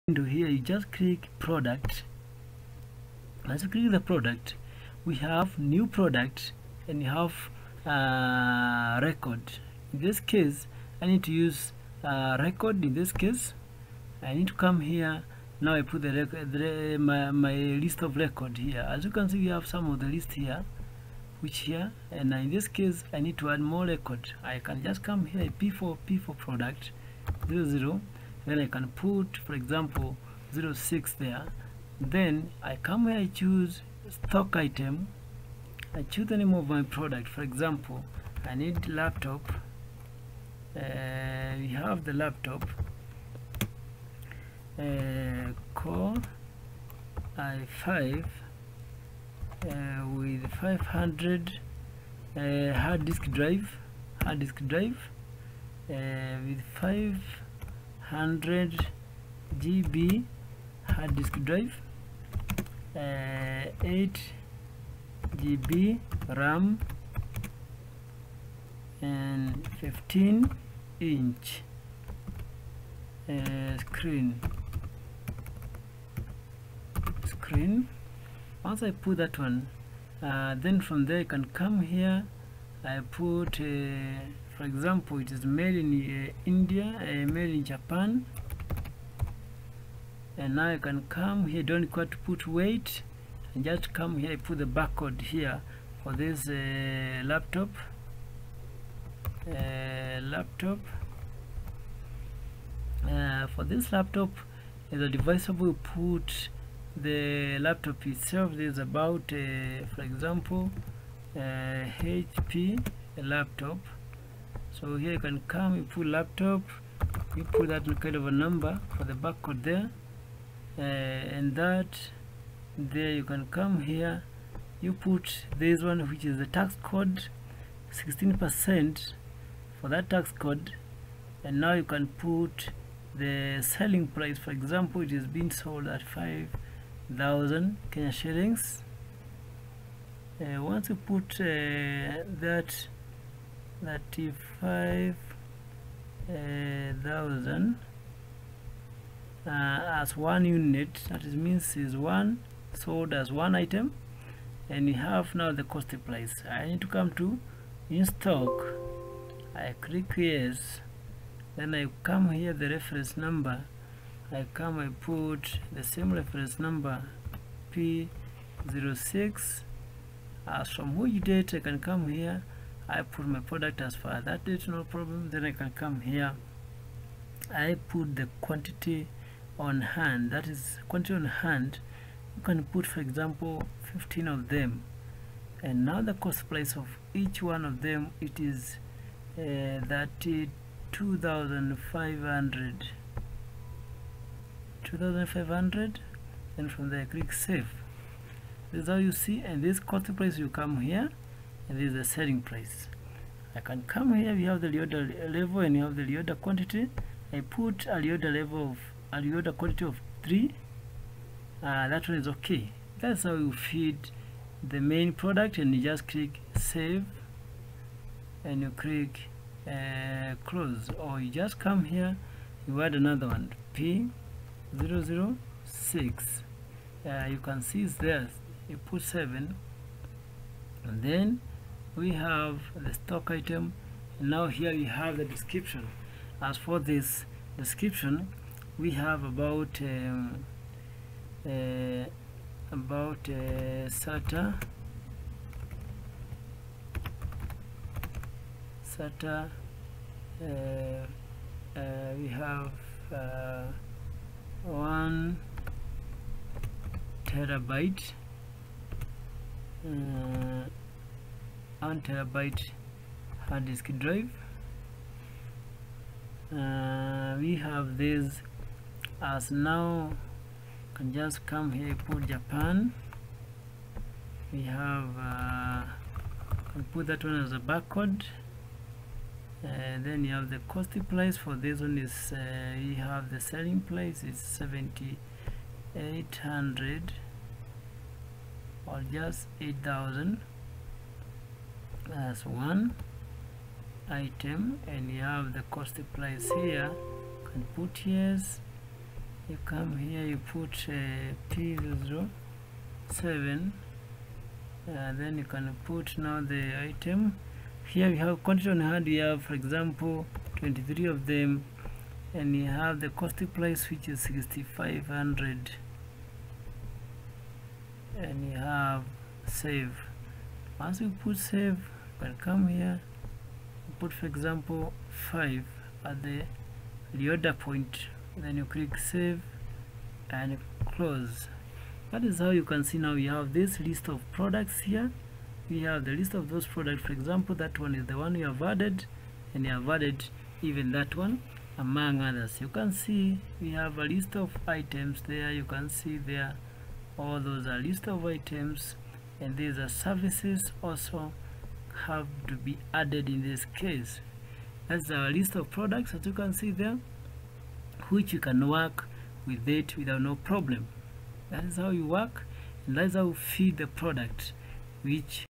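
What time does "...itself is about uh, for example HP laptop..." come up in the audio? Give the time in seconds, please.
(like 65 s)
108 s.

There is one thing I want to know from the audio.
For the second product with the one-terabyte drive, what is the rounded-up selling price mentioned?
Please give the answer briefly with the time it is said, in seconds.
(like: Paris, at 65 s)
8000, at 289 s.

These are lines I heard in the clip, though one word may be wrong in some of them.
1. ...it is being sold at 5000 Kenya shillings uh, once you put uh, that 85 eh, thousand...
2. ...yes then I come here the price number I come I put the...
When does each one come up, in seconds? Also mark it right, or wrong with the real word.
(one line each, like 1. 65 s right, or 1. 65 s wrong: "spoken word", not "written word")
1. 135 s wrong: "35", not "85"
2. 160 s wrong: "reference", not "price".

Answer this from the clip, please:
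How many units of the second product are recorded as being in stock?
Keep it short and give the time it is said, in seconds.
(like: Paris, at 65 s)
23, at 310 s.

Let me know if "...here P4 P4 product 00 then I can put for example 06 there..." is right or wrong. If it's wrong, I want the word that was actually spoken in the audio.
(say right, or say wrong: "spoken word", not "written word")
right.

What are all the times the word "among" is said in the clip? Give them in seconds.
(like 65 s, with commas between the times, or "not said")
341 s.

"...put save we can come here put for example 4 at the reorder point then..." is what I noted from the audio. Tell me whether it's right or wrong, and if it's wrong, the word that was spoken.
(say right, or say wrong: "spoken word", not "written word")
wrong: "5", not "4".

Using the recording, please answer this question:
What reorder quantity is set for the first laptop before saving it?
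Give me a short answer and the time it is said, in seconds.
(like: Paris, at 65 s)
3, at 210 s.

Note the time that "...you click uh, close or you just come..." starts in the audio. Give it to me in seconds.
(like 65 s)
218 s.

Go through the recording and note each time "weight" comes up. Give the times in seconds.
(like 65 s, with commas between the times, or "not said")
92 s.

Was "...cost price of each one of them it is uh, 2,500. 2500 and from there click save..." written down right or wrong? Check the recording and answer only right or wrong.
right.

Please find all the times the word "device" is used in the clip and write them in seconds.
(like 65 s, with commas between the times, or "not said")
105 s.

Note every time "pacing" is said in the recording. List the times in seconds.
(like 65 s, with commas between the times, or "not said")
not said.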